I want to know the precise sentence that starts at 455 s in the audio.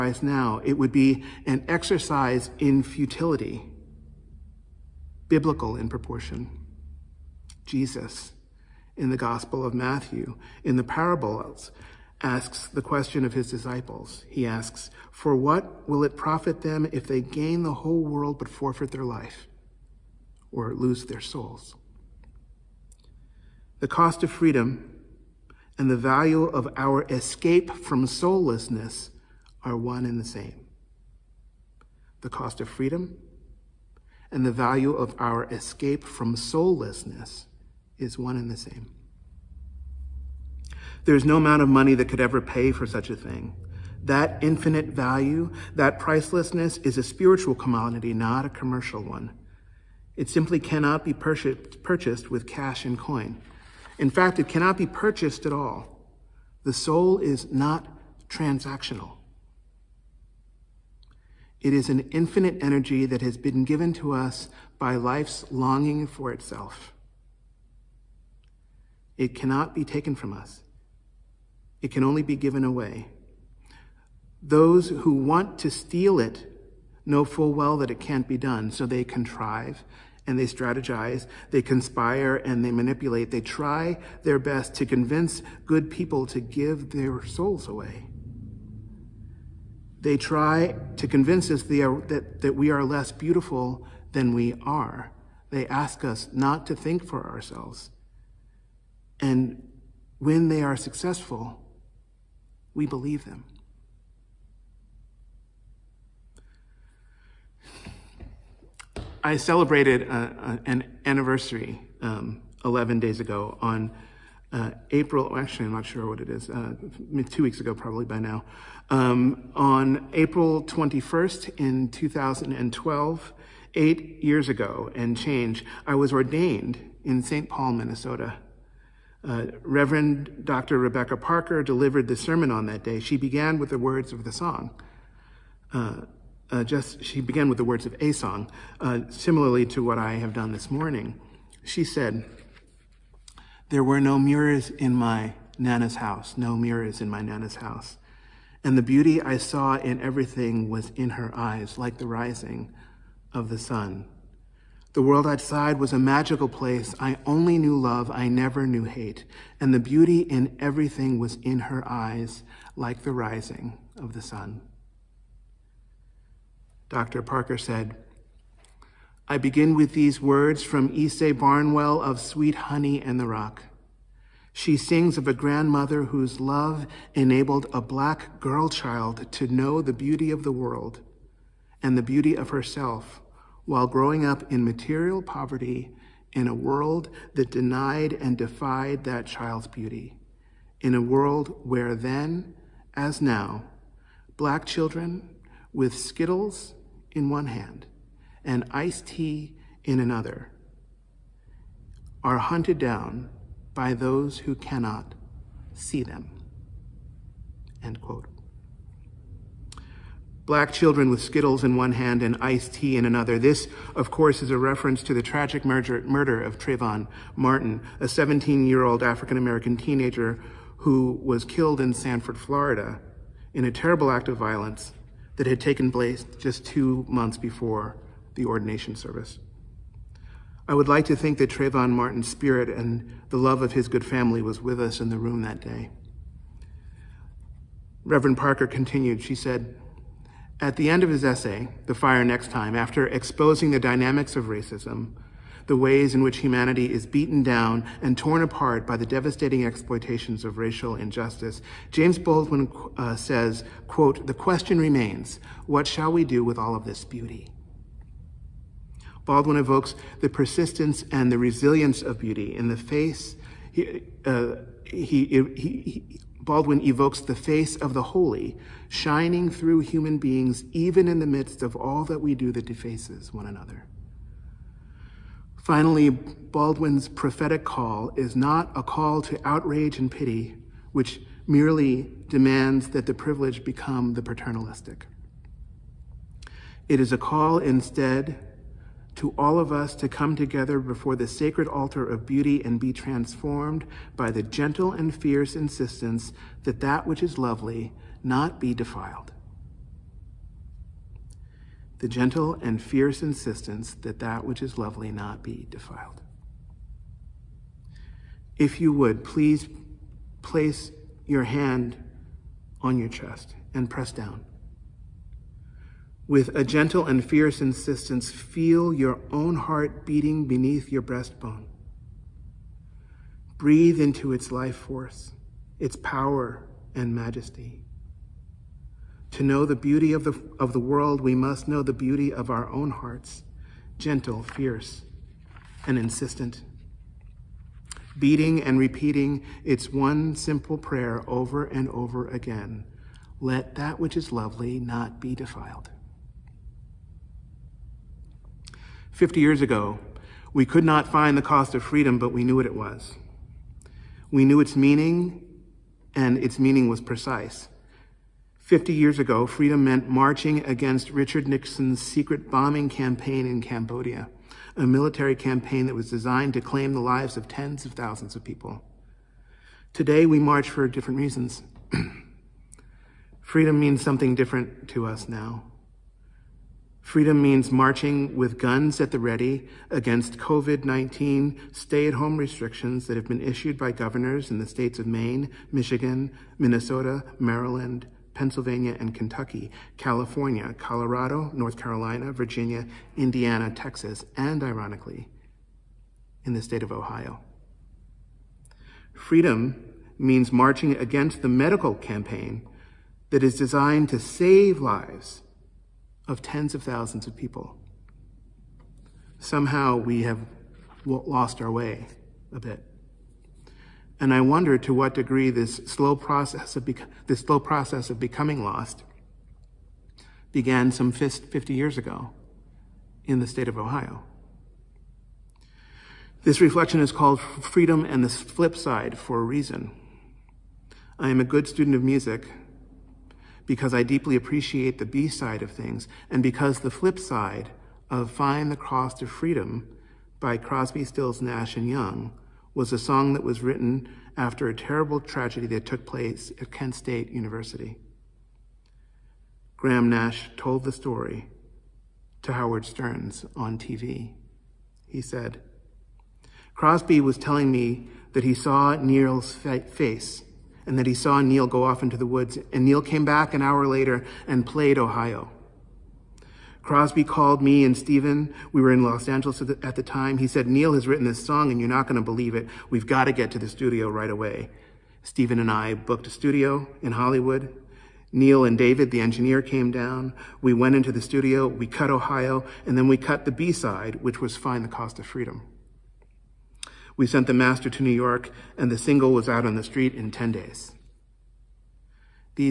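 He said, Crosby was telling me that he saw Neil's face and that he saw Neil go off into the woods.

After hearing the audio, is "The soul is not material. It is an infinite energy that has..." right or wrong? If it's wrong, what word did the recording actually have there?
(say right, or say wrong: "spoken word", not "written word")
wrong: "transactional", not "material".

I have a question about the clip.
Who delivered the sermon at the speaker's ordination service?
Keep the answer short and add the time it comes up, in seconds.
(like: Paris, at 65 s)
Rebecca Parker, at 130 s.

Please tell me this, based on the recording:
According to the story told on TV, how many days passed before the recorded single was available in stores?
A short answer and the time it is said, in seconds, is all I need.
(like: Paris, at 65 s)
10, at 490 s.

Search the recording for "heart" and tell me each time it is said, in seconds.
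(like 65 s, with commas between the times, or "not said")
319 s, 332 s.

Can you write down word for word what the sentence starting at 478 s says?
Neil and David, the engineer, came down.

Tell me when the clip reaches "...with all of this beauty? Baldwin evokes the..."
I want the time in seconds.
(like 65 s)
256 s.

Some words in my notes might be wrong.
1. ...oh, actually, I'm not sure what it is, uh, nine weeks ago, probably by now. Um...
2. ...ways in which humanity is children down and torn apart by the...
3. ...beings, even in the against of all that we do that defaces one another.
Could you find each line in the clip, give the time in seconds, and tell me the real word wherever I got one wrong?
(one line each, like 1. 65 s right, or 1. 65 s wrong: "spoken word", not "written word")
1. 115 s wrong: "two", not "nine"
2. 245 s wrong: "beaten", not "children"
3. 270 s wrong: "midst", not "against".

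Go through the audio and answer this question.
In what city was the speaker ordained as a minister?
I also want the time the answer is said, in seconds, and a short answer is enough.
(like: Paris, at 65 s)
St. Paul, Minnesota, at 127 s.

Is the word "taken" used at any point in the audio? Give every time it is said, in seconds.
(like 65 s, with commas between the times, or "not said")
69 s, 225 s.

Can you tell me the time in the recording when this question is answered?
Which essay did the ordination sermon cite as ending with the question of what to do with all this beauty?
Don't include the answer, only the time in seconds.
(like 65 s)
241 s.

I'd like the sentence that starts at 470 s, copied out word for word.
He said, Neil has written this song and you're not going to believe it.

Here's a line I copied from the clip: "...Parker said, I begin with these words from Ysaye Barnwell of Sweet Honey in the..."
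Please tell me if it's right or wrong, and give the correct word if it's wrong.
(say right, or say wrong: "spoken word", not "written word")
right.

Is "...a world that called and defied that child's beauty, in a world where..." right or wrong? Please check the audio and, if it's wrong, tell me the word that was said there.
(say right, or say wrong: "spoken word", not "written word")
wrong: "denied", not "called".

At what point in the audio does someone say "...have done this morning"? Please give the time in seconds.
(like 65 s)
140 s.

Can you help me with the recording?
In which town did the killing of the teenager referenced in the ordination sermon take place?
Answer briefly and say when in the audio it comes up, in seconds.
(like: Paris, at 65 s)
Sanford, Florida, at 221 s.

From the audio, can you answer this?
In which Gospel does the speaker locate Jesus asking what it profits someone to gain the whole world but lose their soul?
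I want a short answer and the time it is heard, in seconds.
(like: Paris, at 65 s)
Matthew, at 9 s.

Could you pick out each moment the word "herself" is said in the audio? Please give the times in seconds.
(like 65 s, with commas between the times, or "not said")
182 s.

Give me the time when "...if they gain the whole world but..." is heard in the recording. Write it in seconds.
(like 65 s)
16 s.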